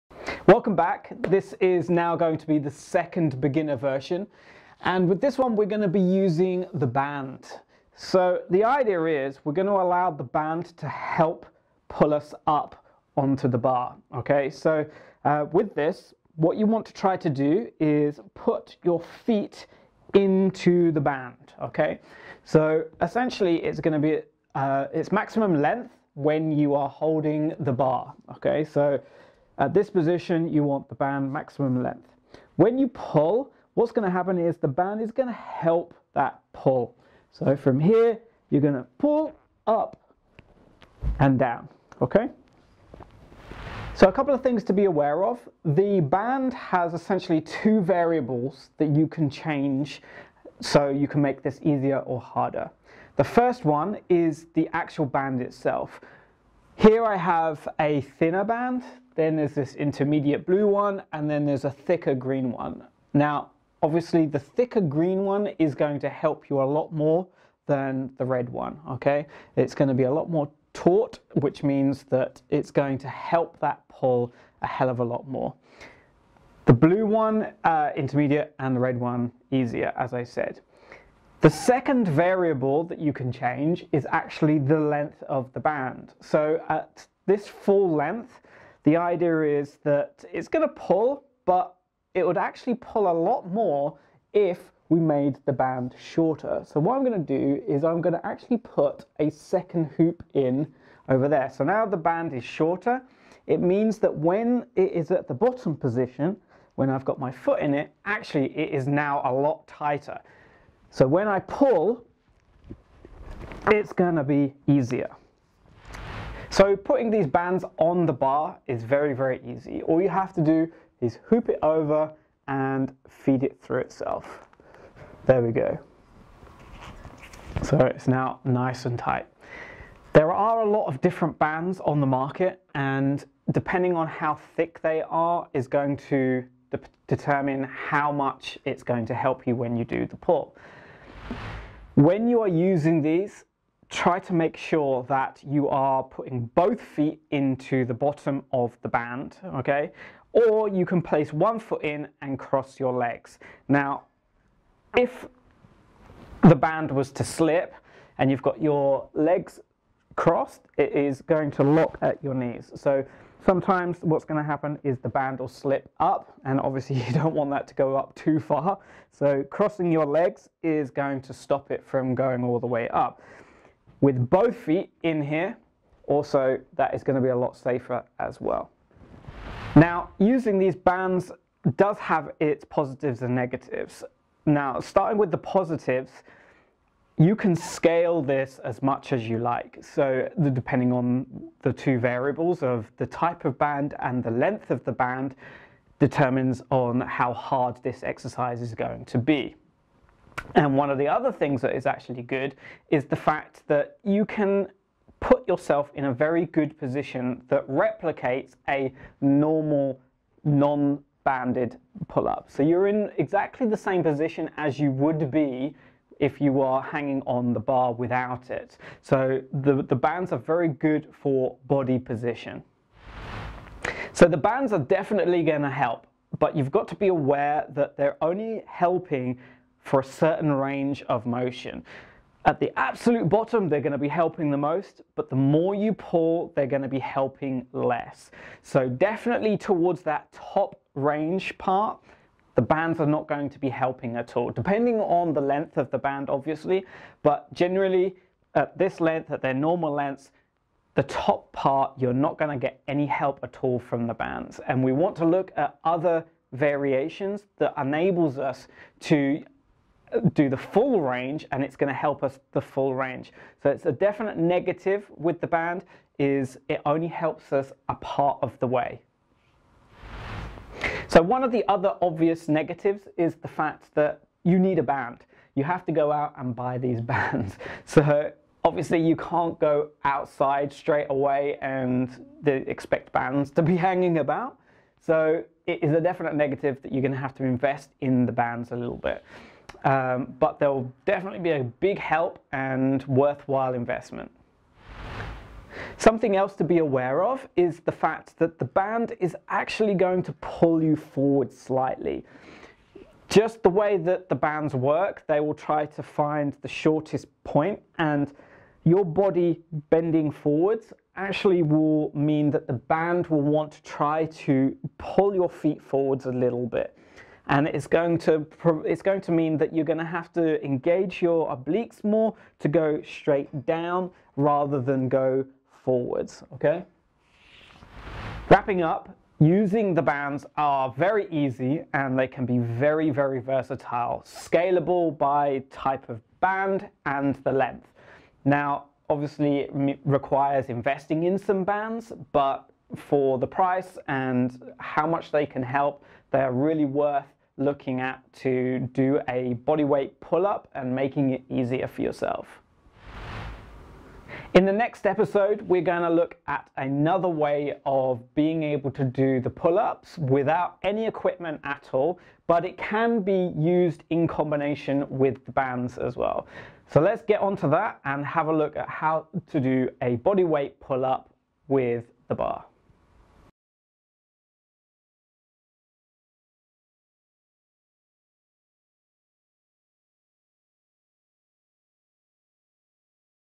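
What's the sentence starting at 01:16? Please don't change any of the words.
The blue one, uh, intermediate, and the red one, easier, as I said.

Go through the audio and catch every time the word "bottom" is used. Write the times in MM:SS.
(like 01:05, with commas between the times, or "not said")
01:45, 02:27, 03:53.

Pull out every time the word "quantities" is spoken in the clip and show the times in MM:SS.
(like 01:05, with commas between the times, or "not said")
not said.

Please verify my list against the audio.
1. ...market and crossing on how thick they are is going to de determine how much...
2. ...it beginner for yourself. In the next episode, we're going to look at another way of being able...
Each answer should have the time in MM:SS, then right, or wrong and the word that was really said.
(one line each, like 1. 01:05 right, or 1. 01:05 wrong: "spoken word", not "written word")
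1. 02:12 wrong: "depending", not "crossing"
2. 05:51 wrong: "easier", not "beginner".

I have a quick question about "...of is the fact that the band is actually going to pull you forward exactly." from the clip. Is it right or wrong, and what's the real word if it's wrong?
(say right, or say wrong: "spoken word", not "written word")
wrong: "slightly", not "exactly".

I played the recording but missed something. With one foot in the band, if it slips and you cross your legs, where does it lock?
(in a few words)
Knees.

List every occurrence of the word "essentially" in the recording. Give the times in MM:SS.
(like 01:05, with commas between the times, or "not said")
00:23, 00:46.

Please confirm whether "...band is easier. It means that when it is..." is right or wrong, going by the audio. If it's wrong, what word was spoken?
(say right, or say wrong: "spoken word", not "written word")
wrong: "shorter", not "easier".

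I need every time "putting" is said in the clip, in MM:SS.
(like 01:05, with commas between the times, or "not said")
01:56, 02:26.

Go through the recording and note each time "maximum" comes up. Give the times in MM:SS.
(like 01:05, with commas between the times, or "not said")
00:25, 00:31.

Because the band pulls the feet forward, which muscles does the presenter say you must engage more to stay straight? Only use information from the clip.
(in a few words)
Obliques.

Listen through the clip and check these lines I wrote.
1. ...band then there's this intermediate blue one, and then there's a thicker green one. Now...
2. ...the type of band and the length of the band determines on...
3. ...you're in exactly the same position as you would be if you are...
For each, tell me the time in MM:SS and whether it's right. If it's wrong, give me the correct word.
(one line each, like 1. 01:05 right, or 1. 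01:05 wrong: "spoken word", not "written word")
1. 00:58 right
2. 03:12 right
3. 03:32 right.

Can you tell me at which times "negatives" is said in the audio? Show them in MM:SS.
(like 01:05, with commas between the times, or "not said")
03:03, 04:24, 04:32, 04:46.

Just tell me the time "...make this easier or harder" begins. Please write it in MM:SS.
00:51.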